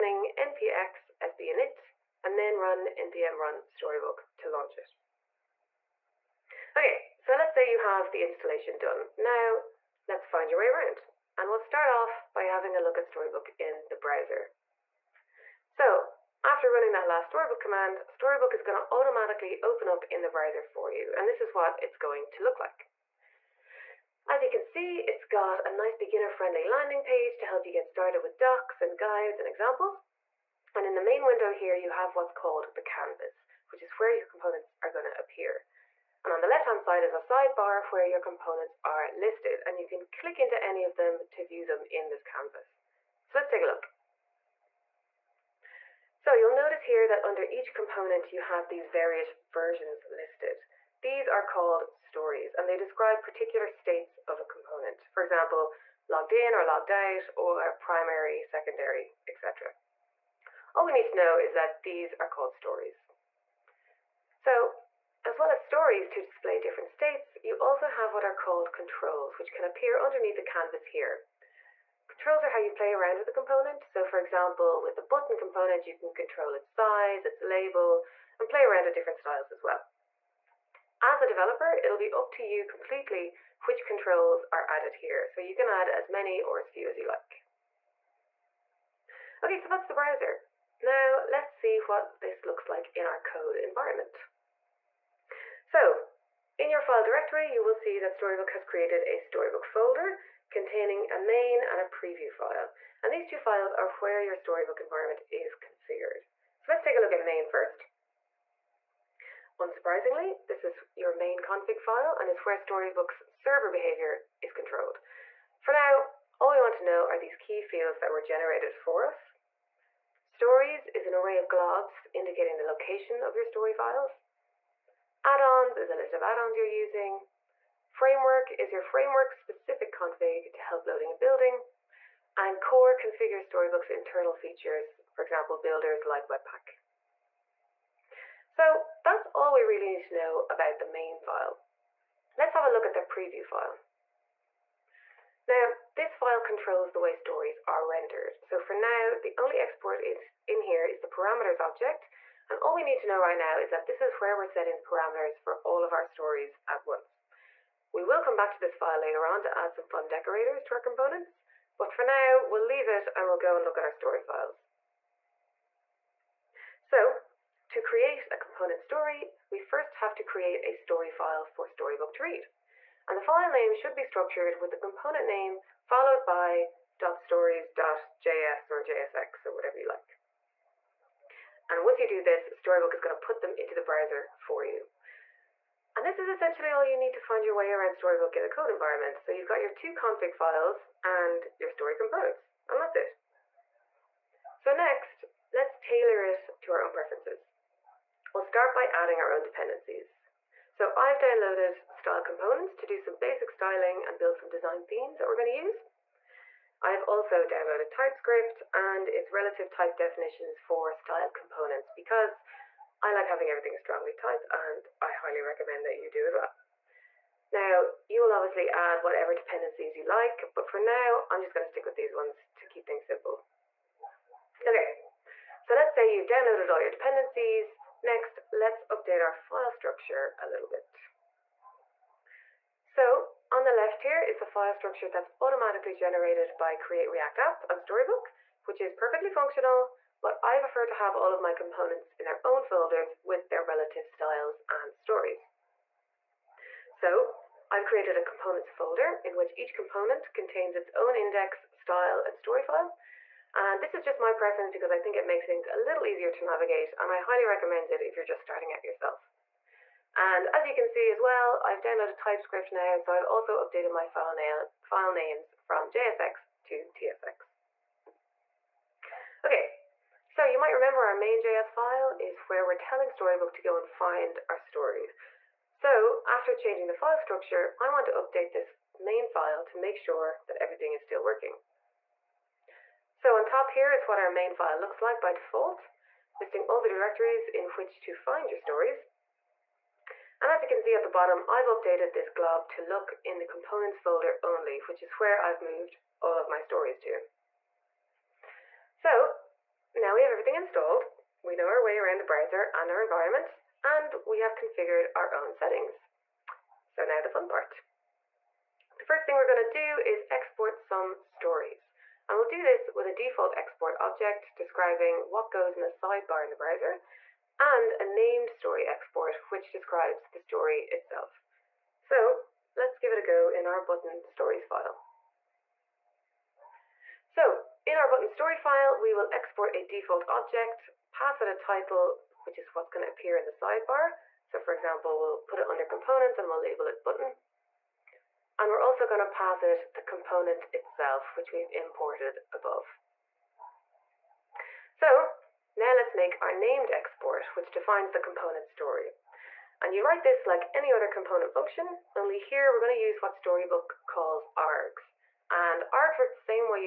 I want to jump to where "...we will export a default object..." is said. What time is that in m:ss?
5:28.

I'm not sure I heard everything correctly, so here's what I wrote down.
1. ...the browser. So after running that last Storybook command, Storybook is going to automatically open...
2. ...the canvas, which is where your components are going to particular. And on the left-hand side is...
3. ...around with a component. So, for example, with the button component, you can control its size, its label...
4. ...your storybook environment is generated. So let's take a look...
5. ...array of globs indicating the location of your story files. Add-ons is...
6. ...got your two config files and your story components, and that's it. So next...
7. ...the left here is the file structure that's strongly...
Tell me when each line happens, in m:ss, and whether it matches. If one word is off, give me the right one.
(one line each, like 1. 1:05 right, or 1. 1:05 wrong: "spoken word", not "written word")
1. 0:13 right
2. 0:32 wrong: "appear", not "particular"
3. 1:12 right
4. 1:44 wrong: "configured", not "generated"
5. 2:01 right
6. 3:09 right
7. 3:53 wrong: "automatically", not "strongly".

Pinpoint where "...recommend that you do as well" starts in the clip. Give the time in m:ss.
3:35.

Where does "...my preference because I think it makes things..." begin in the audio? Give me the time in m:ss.
4:14.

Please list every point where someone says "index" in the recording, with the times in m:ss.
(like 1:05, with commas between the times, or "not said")
4:11.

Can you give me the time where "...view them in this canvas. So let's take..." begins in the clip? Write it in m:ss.
0:41.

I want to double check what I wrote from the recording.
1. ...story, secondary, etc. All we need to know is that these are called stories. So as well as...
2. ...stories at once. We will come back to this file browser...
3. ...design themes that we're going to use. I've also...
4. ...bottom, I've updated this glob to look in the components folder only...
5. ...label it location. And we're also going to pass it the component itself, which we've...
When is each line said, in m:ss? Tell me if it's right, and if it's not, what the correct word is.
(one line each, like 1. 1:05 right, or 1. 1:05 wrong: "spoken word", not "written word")
1. 0:57 wrong: "primary", not "story"
2. 2:36 wrong: "later", not "browser"
3. 3:24 right
4. 4:51 right
5. 5:36 wrong: "button", not "location".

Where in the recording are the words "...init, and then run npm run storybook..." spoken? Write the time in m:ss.
0:01.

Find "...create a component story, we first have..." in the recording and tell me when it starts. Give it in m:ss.
2:47.